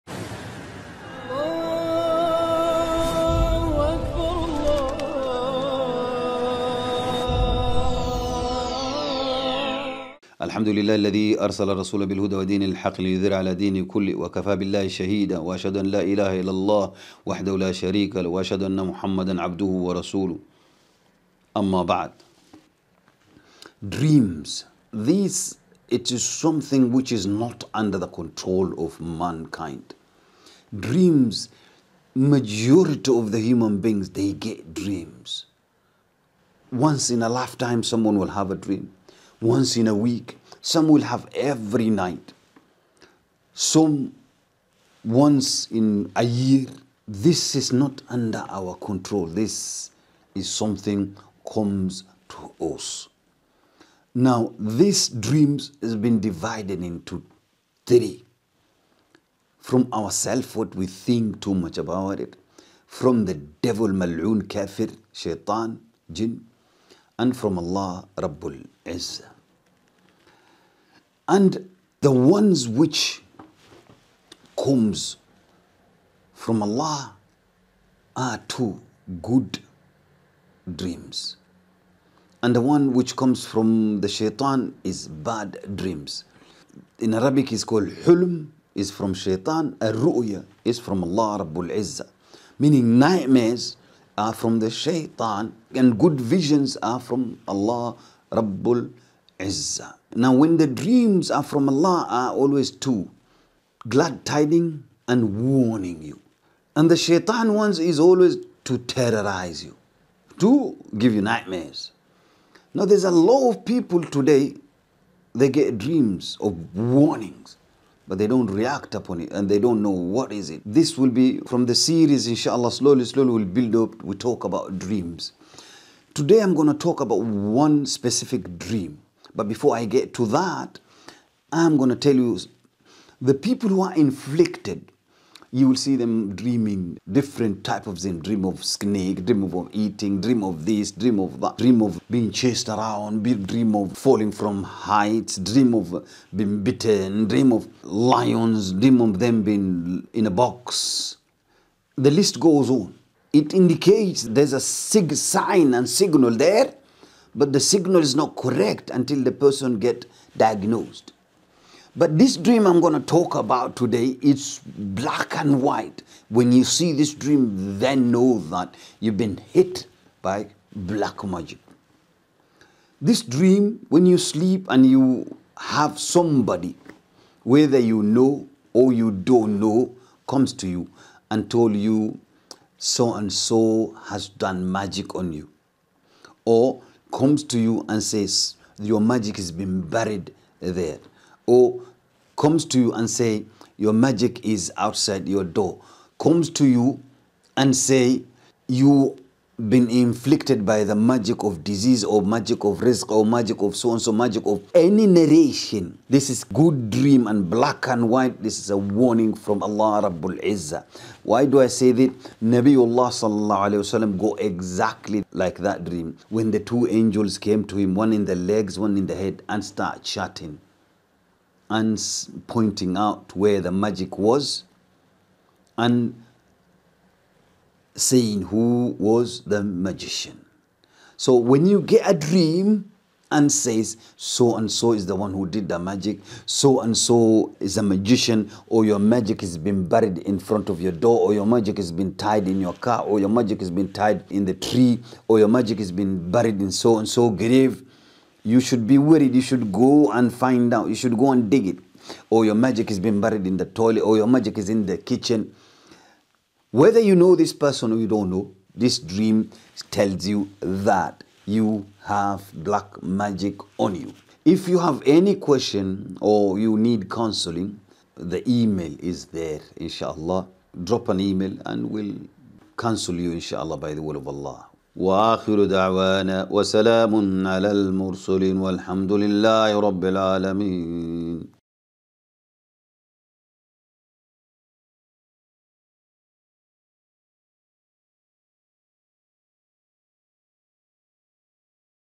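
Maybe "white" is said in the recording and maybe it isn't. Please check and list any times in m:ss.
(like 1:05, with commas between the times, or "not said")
2:45, 3:28.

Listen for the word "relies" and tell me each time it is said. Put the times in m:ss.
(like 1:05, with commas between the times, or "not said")
not said.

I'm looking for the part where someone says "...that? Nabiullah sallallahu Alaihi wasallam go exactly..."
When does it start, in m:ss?
3:31.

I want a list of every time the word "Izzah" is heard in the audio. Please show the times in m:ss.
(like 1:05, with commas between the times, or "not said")
1:08, 1:31, 3:30.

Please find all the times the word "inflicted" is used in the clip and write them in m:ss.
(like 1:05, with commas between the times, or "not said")
2:13, 3:19.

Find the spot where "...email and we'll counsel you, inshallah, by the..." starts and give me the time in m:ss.
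4:31.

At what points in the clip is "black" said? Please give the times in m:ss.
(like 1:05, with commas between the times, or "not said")
2:44, 2:50, 3:27, 4:22.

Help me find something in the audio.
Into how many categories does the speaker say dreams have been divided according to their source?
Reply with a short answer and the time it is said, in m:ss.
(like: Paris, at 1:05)
3, at 0:57.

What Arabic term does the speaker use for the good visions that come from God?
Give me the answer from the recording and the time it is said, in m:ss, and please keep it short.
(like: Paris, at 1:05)
ruya, at 1:29.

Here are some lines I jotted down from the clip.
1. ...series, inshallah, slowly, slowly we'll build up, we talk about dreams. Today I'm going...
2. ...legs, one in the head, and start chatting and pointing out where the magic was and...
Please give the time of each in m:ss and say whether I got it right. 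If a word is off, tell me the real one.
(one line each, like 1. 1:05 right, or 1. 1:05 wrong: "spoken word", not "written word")
1. 2:01 right
2. 3:38 right.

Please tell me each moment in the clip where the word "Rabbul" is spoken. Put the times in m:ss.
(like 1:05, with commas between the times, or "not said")
1:08, 1:31, 1:38, 3:30.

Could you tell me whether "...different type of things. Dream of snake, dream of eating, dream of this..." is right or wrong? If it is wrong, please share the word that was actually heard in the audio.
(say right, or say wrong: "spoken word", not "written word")
right.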